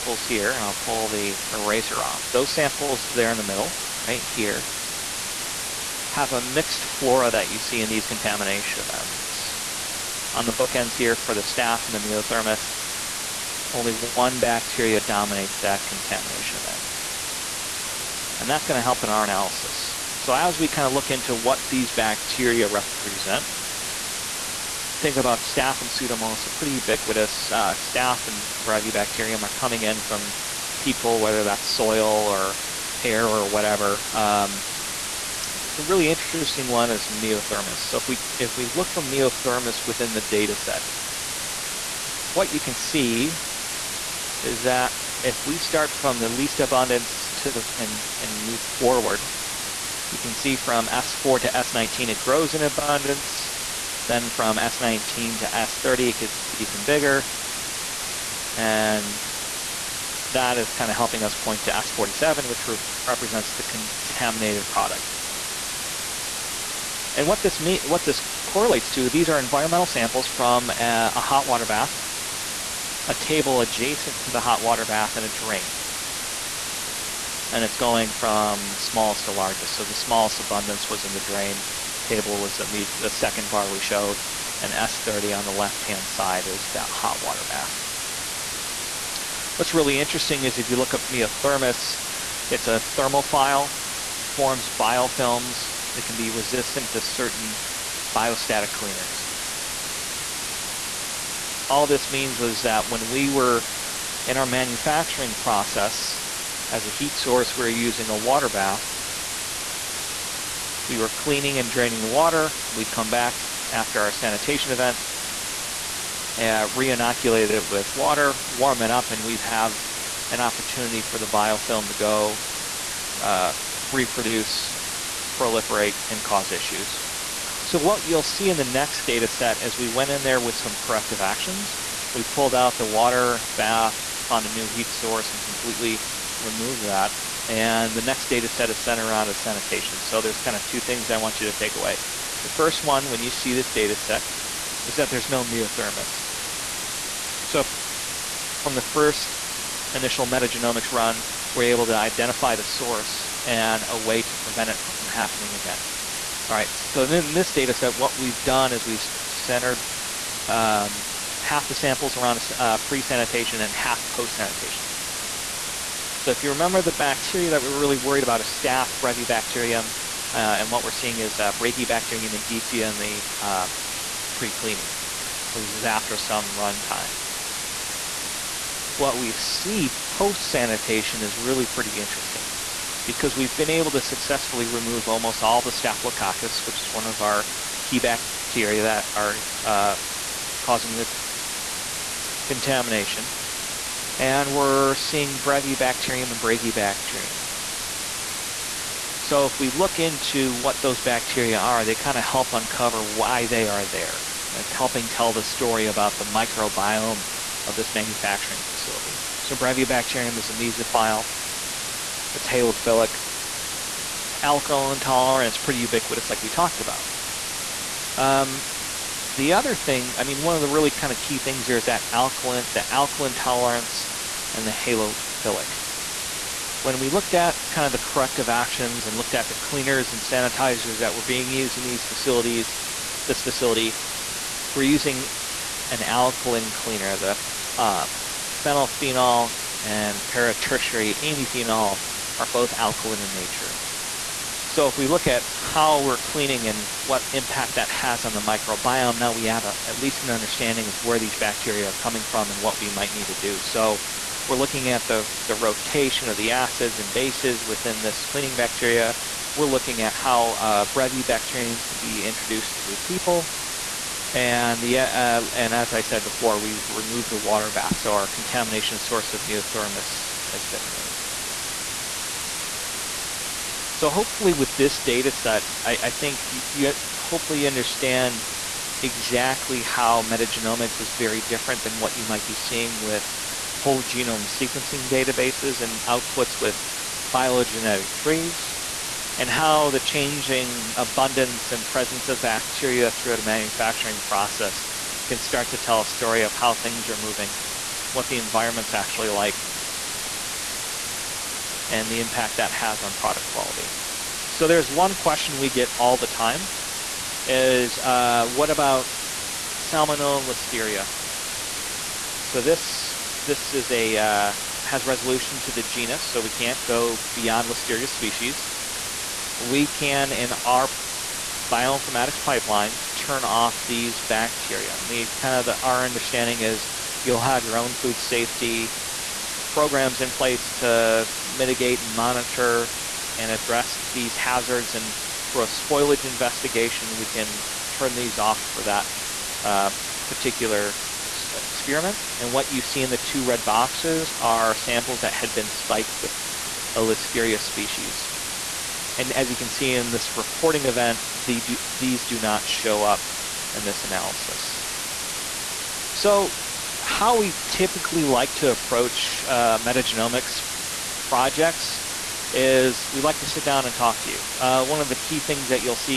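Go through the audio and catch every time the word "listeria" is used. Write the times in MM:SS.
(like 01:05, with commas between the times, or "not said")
05:10, 05:17, 05:47.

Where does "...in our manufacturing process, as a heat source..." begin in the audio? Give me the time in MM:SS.
01:44.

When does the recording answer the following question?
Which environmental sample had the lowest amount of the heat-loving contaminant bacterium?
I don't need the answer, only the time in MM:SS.
01:21.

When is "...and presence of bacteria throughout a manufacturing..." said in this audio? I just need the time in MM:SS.
04:51.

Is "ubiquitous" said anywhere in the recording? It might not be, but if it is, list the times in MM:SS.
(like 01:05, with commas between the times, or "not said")
00:26, 03:35.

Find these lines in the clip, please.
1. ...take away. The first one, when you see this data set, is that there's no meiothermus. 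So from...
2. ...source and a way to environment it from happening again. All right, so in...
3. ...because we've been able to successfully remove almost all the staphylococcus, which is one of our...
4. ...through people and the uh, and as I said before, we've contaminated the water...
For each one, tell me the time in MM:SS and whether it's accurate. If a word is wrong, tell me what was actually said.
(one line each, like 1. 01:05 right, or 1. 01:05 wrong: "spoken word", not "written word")
1. 02:21 right
2. 02:32 wrong: "prevent", not "environment"
3. 03:03 right
4. 04:22 wrong: "removed", not "contaminated".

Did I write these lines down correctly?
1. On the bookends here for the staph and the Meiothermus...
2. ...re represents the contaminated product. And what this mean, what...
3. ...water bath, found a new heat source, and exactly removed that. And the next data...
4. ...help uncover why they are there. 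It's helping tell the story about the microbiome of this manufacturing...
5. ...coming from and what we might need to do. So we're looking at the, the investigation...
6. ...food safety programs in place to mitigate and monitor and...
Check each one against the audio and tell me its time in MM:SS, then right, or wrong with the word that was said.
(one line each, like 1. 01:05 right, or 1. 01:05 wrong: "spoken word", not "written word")
1. 00:10 right
2. 01:02 right
3. 02:12 wrong: "completely", not "exactly"
4. 03:22 right
5. 04:11 wrong: "rotation", not "investigation"
6. 05:27 right.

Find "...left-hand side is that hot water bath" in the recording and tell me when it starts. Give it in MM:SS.
01:25.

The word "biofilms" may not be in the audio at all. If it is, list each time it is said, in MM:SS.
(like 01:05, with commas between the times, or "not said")
01:34, 02:01.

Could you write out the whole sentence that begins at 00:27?
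Uh, staph and brevibacterium are coming in from people, whether that's soil or hair or whatever.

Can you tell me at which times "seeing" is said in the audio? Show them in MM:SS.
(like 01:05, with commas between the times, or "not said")
02:50, 03:14, 04:42.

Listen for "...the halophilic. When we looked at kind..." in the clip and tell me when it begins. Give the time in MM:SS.
03:44.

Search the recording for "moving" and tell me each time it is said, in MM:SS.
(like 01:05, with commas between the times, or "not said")
04:57.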